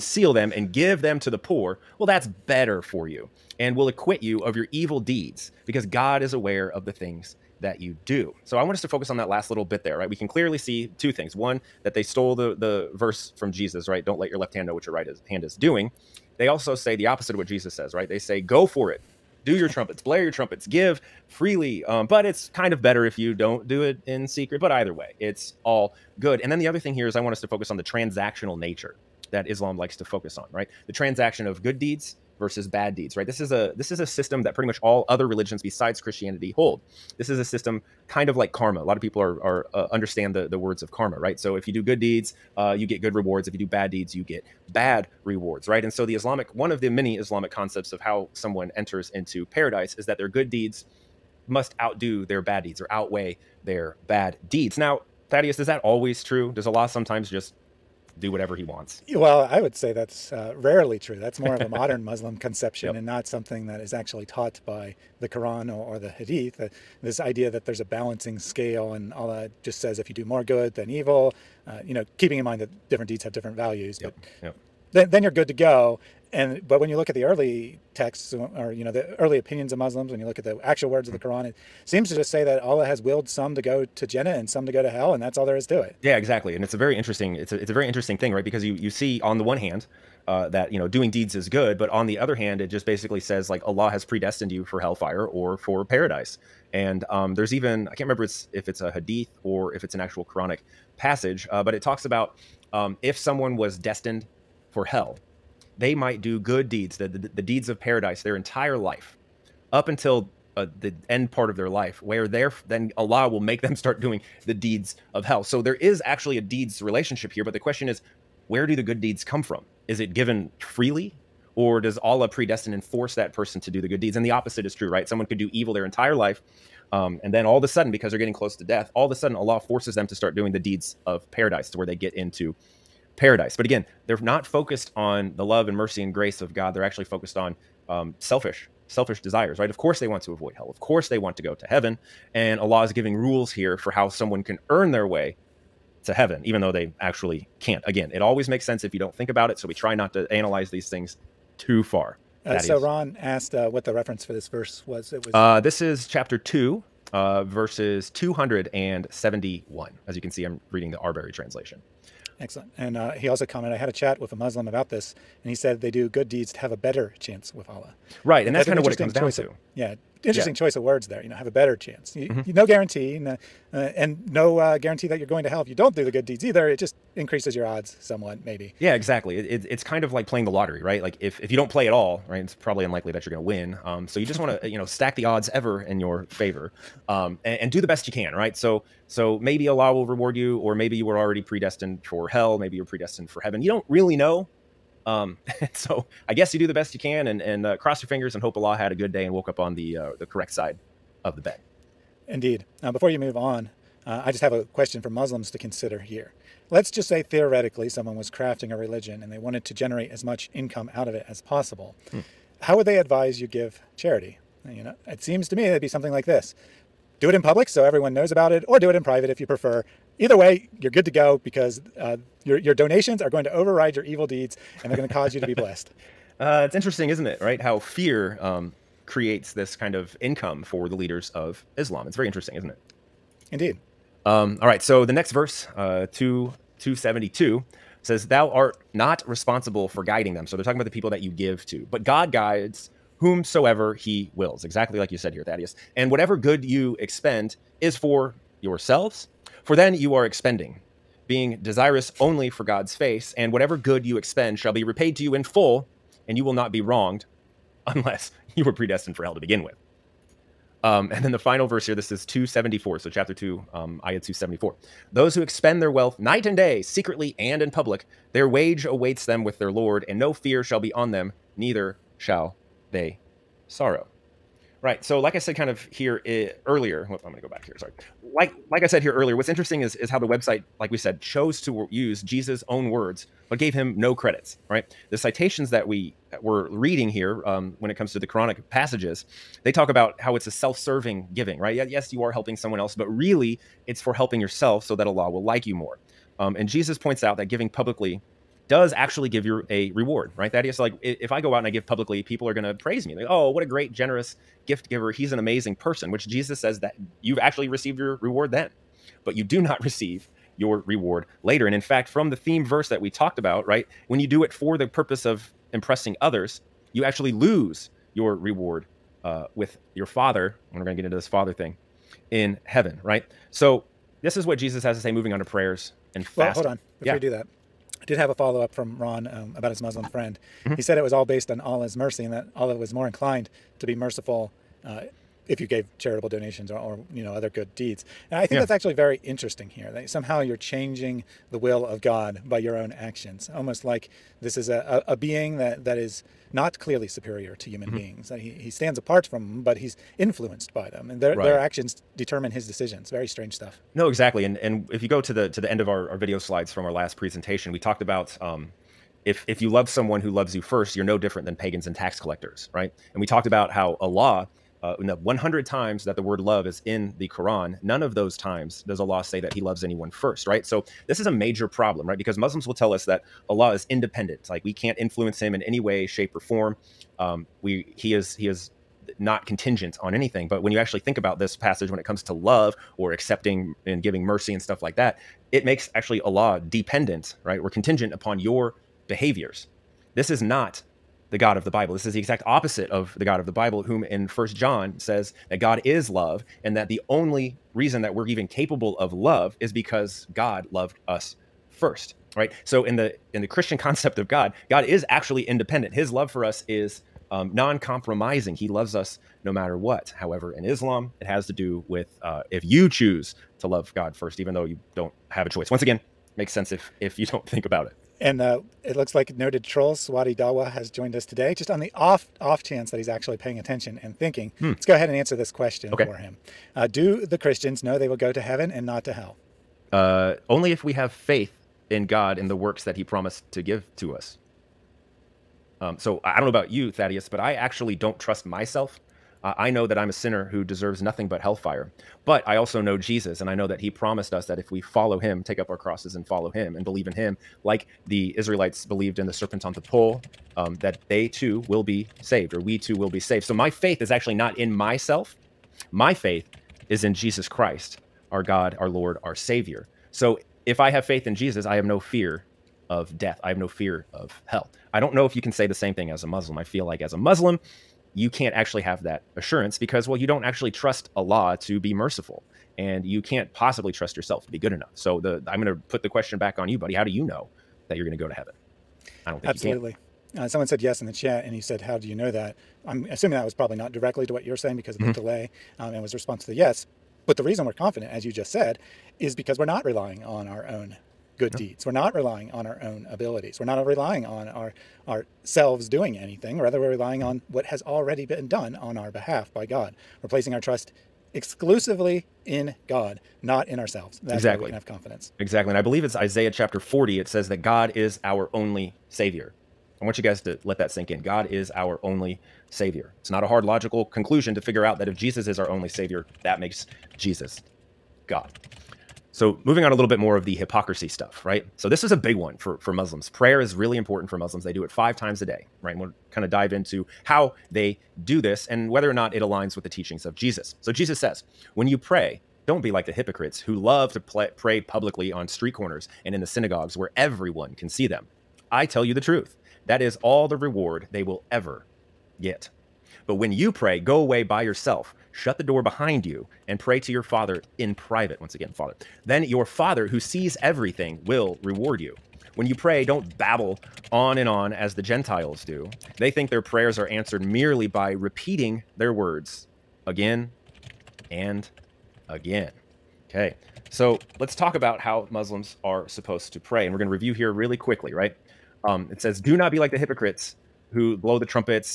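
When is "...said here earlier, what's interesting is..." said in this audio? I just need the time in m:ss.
4:38.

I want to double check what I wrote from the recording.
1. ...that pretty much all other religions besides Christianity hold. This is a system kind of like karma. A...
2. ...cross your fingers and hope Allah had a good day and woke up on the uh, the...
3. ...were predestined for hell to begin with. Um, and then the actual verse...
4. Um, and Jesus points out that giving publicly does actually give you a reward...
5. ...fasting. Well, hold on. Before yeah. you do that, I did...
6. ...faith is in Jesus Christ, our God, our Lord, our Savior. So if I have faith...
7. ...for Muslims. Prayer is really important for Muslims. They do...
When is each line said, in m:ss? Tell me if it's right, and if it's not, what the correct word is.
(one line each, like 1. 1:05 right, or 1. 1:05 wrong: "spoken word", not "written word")
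1. 0:34 right
2. 3:17 right
3. 4:18 wrong: "final", not "actual"
4. 4:56 right
5. 5:26 right
6. 7:36 right
7. 8:42 right.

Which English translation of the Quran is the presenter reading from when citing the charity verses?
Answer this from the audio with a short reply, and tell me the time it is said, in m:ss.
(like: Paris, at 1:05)
Arberry, at 2:40.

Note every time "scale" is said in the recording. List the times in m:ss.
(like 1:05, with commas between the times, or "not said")
1:08.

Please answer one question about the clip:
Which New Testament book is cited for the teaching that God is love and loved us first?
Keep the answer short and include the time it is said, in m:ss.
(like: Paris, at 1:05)
First John, at 6:34.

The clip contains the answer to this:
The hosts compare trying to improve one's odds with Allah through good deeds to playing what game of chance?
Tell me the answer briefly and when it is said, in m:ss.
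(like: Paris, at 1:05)
The lottery, at 3:00.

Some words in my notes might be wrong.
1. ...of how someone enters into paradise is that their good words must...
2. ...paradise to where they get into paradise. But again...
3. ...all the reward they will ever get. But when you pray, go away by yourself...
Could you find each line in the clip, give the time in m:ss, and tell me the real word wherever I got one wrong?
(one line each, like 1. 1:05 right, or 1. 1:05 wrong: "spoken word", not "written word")
1. 0:47 wrong: "deeds", not "words"
2. 2:11 right
3. 9:00 right.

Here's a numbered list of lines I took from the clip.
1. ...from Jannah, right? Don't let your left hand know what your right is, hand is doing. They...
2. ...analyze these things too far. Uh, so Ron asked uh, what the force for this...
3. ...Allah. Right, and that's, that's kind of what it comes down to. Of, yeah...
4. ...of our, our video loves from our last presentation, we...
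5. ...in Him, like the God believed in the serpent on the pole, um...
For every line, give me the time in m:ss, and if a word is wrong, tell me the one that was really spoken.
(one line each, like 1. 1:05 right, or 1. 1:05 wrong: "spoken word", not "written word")
1. 0:13 wrong: "Jesus", not "Jannah"
2. 2:30 wrong: "reference", not "force"
3. 2:47 right
4. 5:55 wrong: "slides", not "loves"
5. 7:27 wrong: "Israelites", not "God".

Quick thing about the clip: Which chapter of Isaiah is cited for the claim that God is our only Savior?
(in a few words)
Chapter 40.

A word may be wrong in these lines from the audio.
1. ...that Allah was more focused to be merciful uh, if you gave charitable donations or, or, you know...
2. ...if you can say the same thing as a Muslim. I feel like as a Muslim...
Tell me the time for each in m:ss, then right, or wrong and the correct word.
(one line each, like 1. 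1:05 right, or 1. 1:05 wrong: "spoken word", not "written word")
1. 5:32 wrong: "inclined", not "focused"
2. 7:45 right.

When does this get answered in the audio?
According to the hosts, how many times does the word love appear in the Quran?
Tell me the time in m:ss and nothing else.
6:05.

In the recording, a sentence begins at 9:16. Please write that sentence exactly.
They think their prayers are answered merely by repeating their words again and again.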